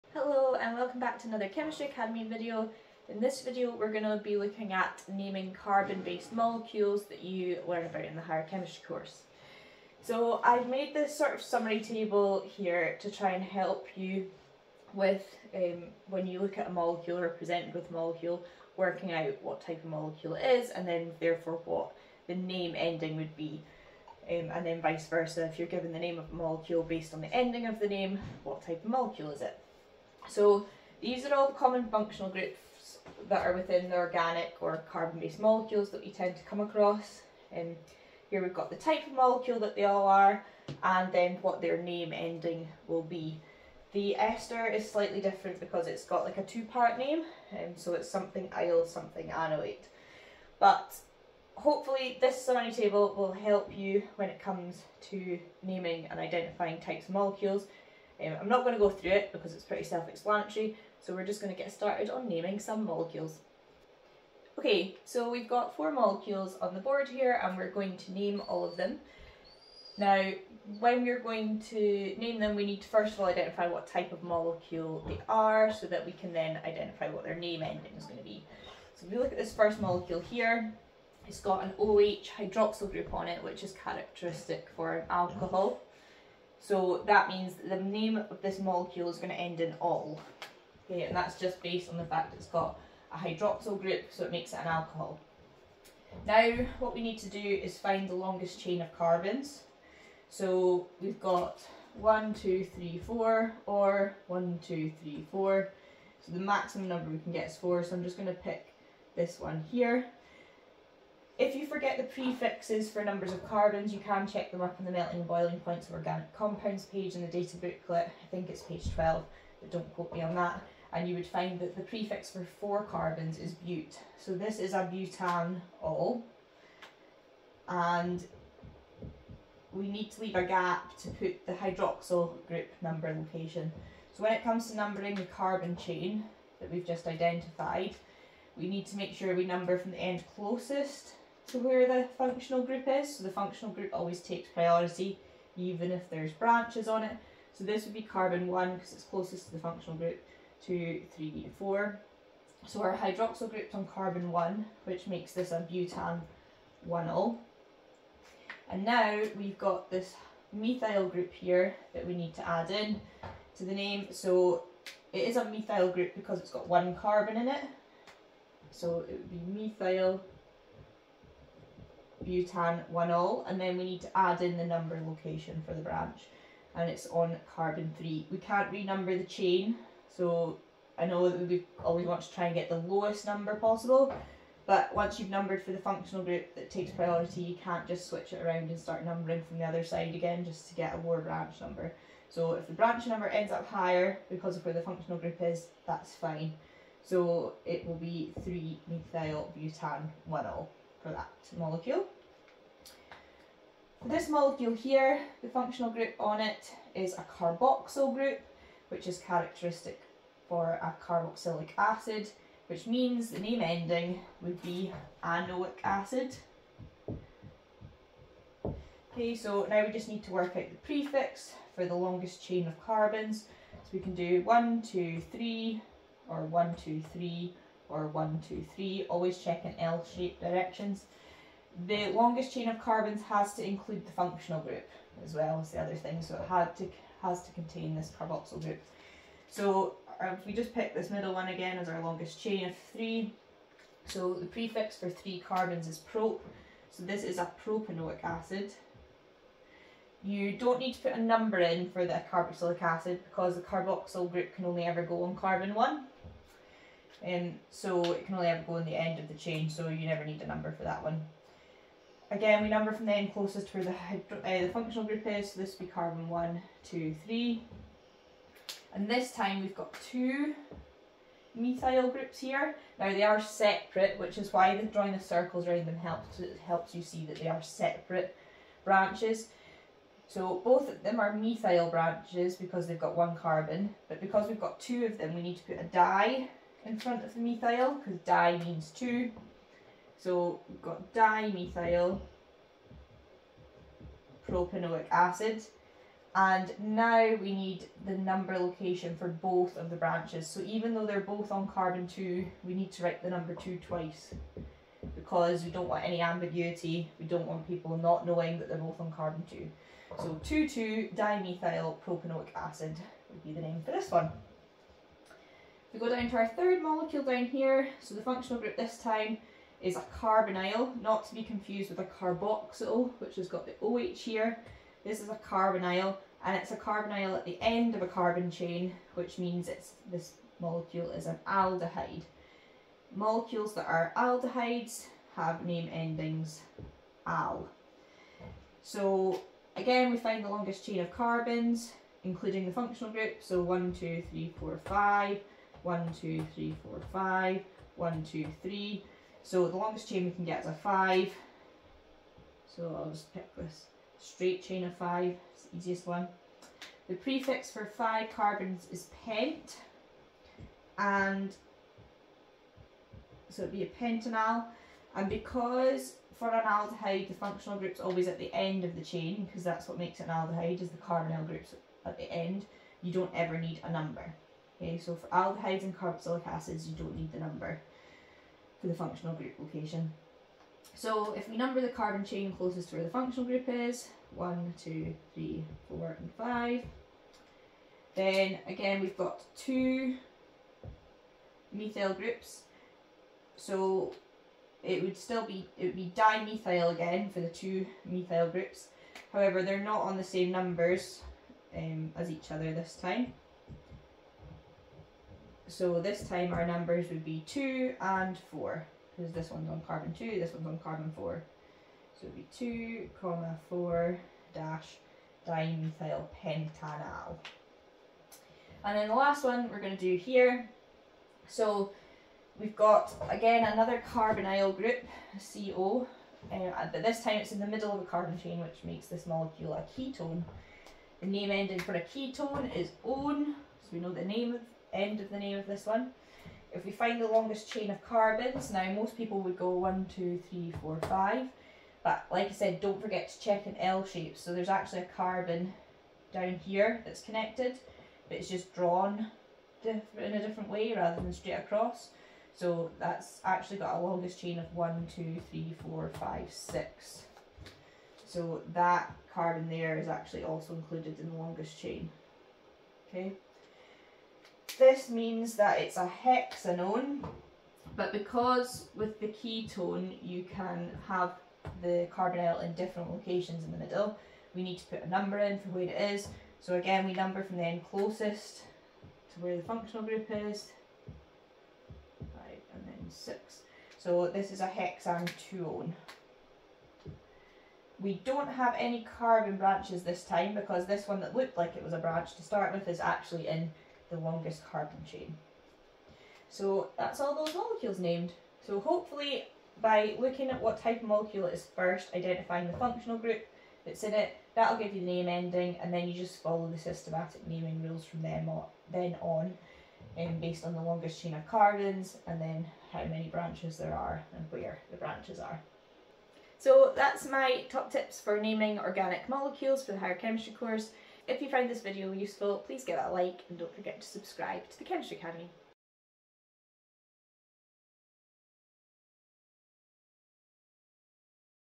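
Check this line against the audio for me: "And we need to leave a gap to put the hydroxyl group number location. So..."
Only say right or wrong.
right.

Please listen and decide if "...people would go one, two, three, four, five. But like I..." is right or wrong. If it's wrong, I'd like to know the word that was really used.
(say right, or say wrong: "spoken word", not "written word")
right.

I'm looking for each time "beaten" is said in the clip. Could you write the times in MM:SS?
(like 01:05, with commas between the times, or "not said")
not said.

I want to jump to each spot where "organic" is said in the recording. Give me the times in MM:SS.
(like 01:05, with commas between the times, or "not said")
00:33, 01:55, 08:38.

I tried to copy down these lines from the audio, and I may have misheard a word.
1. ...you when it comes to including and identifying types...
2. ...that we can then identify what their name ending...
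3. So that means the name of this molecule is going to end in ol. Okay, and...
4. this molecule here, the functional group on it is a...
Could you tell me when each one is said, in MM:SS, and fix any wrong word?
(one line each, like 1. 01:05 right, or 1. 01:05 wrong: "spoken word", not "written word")
1. 00:53 wrong: "naming", not "including"
2. 01:15 right
3. 01:26 right
4. 03:24 right.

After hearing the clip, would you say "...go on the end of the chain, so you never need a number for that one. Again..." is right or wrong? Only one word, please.
right.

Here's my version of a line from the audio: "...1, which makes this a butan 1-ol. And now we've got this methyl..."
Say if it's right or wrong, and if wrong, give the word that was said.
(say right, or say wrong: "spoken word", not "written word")
right.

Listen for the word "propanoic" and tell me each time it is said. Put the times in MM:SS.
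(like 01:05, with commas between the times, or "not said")
04:07, 04:54, 05:12.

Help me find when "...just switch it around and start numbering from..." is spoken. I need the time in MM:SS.
03:07.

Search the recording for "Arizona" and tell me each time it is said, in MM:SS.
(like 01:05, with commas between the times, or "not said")
not said.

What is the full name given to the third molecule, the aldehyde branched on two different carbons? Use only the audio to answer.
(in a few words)
2,4-dimethylpentanal.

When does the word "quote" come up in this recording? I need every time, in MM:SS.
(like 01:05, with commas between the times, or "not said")
01:59.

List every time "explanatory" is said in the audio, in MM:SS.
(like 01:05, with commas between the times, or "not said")
00:59.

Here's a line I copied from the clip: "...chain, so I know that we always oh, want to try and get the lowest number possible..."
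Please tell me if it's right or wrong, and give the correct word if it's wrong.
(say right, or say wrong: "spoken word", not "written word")
right.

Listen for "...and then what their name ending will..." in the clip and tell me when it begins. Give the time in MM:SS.
00:40.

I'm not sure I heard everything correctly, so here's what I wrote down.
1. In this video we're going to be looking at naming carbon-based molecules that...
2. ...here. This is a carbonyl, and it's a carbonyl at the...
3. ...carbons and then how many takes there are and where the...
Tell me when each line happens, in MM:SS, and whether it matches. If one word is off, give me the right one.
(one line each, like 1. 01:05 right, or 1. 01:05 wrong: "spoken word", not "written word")
1. 00:03 right
2. 05:24 right
3. 08:31 wrong: "branches", not "takes".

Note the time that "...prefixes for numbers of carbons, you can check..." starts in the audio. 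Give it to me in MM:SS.
01:52.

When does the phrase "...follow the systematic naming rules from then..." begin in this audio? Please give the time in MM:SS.
08:26.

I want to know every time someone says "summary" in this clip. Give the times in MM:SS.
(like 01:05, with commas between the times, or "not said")
00:11, 00:52.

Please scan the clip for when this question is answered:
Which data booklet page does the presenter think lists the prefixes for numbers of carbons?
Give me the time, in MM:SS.
01:58.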